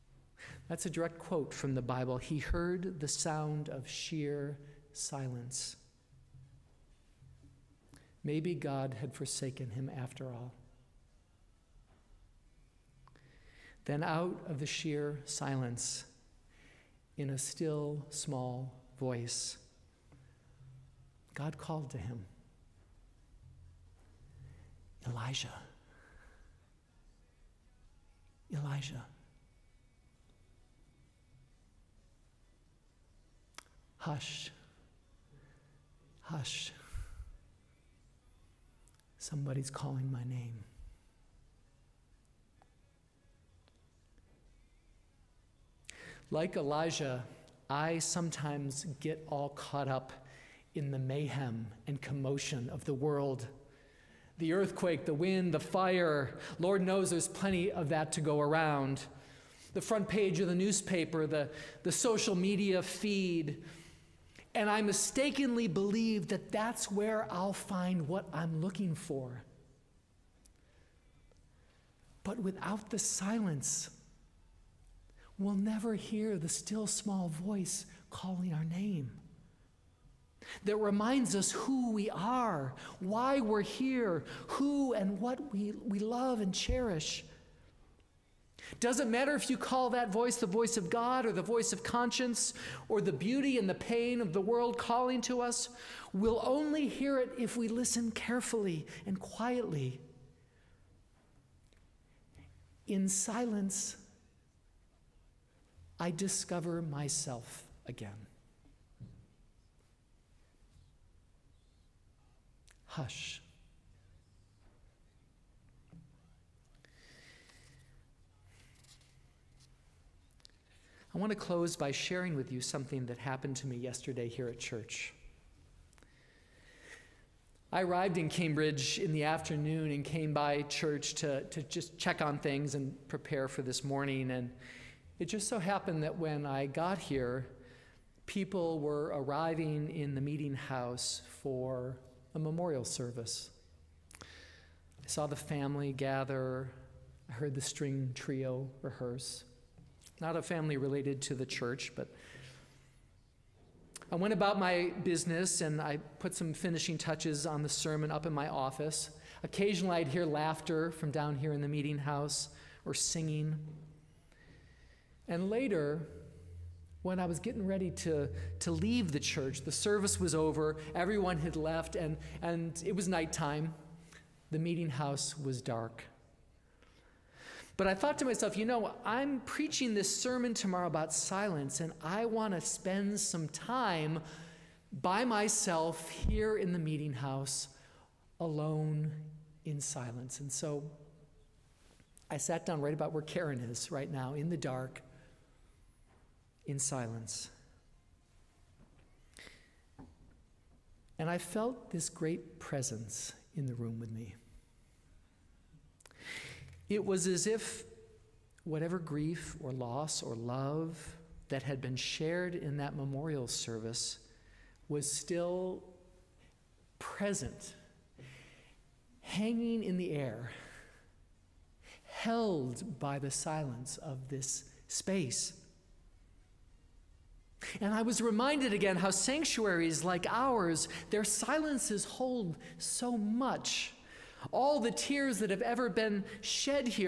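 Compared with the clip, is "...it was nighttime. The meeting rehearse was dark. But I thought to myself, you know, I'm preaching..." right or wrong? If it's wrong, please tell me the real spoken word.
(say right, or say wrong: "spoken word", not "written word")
wrong: "house", not "rehearse".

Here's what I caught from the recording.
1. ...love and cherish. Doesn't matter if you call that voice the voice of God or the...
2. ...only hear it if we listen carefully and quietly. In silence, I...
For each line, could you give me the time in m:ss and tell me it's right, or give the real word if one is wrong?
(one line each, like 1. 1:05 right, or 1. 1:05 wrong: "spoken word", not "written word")
1. 1:25 right
2. 1:36 right.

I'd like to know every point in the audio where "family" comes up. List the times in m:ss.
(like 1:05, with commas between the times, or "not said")
2:25, 2:30.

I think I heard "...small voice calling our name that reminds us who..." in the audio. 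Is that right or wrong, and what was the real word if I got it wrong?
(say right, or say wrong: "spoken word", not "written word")
right.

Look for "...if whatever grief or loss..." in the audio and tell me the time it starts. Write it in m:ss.
3:27.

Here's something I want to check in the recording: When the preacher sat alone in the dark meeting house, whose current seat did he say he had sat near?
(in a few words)
Karen.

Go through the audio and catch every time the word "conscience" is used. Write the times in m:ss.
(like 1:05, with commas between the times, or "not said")
1:31.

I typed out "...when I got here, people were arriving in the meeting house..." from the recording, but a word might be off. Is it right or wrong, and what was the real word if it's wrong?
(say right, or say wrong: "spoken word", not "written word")
right.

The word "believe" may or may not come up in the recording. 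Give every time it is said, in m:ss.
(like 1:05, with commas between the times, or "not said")
1:05.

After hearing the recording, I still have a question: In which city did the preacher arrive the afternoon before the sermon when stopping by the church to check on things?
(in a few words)
Cambridge.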